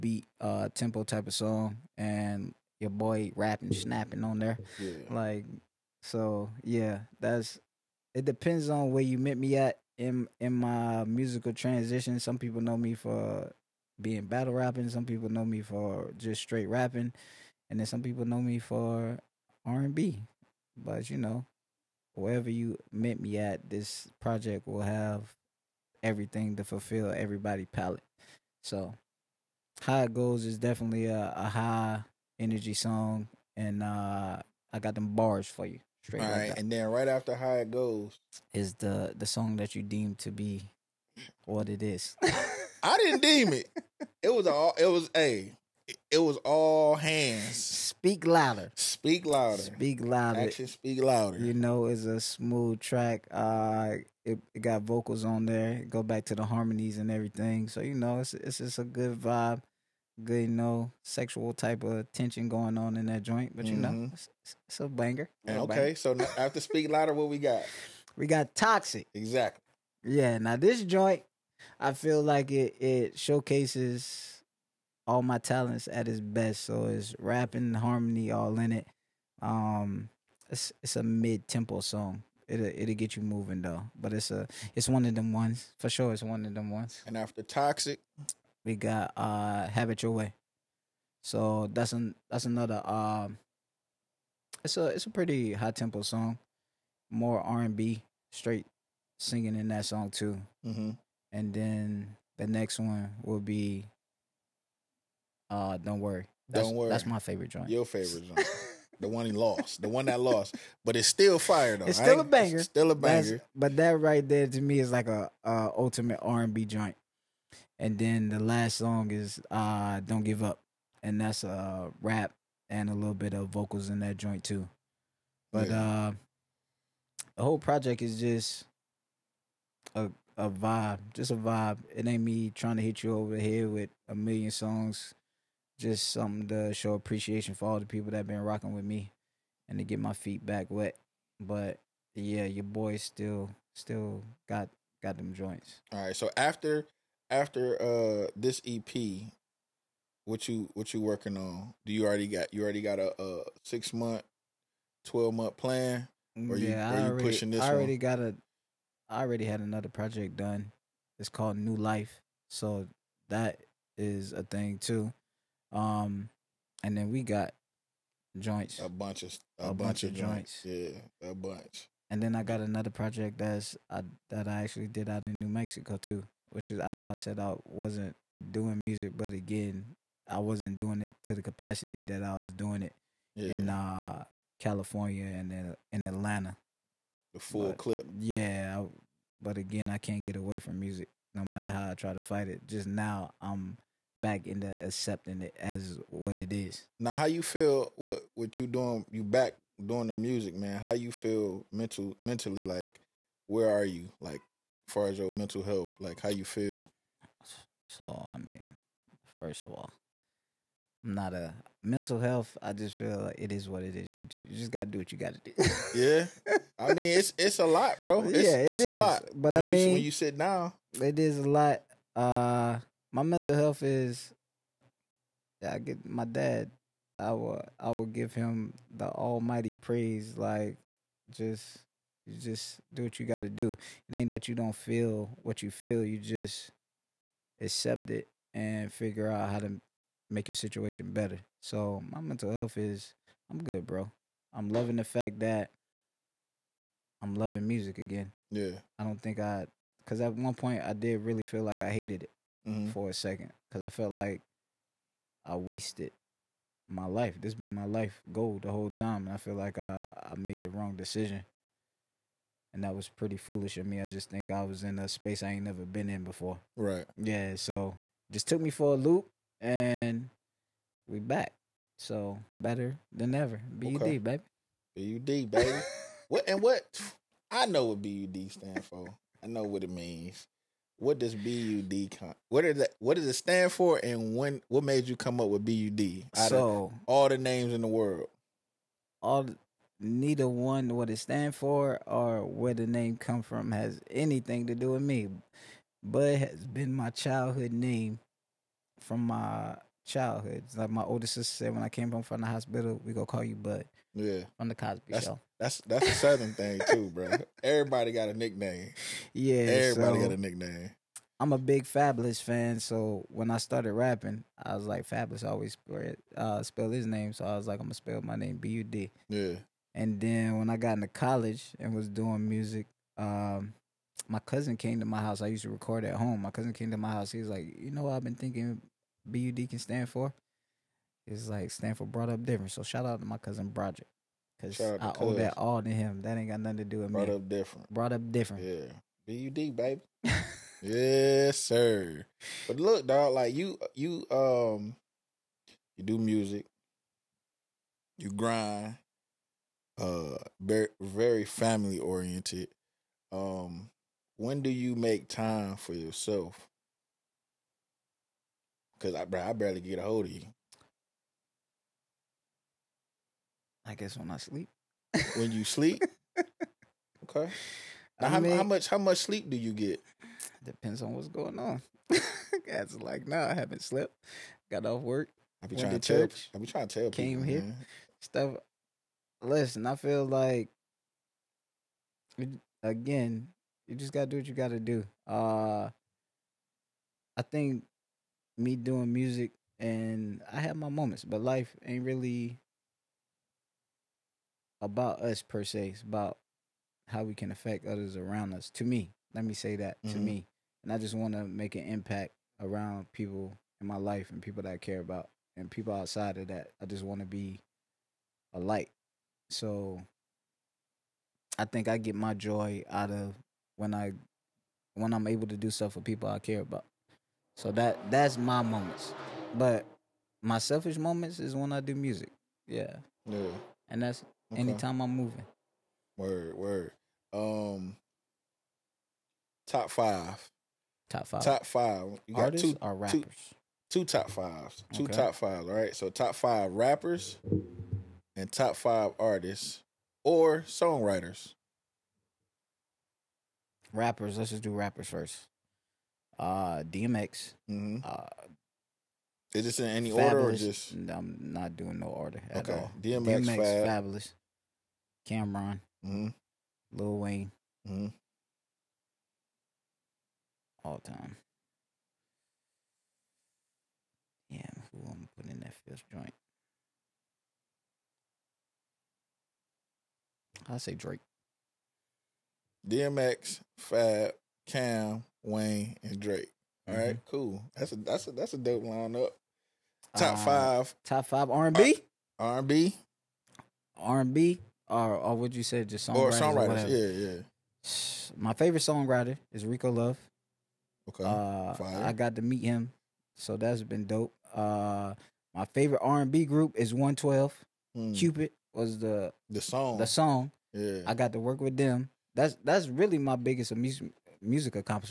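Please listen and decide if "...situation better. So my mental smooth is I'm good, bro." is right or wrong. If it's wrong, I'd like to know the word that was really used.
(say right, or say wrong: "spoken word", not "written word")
wrong: "health", not "smooth".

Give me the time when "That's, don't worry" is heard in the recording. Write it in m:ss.
1:46.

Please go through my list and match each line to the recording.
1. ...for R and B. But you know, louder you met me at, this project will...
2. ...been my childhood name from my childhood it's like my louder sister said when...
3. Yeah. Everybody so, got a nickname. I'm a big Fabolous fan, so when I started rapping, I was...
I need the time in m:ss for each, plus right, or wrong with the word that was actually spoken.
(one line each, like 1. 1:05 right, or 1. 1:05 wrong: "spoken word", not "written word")
1. 0:18 wrong: "wherever", not "louder"
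2. 4:56 wrong: "older", not "louder"
3. 5:09 right.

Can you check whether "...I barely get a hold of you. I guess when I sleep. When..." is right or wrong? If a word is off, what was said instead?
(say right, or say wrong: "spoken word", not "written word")
right.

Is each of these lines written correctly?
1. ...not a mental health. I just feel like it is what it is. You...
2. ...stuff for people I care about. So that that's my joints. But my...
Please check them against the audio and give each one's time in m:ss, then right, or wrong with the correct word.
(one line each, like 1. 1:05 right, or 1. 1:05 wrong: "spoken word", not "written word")
1. 3:31 right
2. 6:55 wrong: "moments", not "joints".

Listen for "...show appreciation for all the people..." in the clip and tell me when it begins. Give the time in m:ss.
2:16.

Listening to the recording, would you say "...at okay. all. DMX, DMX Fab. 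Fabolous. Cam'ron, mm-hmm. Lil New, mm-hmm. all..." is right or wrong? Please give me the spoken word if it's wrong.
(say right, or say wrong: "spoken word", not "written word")
wrong: "Wayne", not "New".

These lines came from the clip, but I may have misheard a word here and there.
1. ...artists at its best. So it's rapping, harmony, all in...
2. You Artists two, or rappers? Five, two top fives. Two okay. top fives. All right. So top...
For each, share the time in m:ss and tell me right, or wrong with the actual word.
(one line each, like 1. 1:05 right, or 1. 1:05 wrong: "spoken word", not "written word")
1. 1:15 wrong: "talents", not "artists"
2. 7:12 wrong: "Two", not "Five".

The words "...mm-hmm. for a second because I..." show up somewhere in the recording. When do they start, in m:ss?
4:12.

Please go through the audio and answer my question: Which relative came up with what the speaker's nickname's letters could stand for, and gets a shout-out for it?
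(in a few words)
Broderick.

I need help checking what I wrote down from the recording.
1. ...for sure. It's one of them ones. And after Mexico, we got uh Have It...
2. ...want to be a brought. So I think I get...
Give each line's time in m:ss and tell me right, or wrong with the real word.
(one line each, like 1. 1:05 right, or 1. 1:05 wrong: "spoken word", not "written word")
1. 1:25 wrong: "Toxic", not "Mexico"
2. 6:47 wrong: "light", not "brought".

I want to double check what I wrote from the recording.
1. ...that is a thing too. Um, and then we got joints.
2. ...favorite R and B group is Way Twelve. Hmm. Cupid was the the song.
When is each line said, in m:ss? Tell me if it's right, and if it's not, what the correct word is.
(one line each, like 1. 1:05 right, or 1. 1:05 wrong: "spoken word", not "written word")
1. 2:43 right
2. 8:15 wrong: "One", not "Way".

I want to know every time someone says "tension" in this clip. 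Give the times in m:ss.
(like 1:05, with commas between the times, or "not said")
1:02.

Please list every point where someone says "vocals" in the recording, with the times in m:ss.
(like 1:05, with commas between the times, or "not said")
0:54, 2:03.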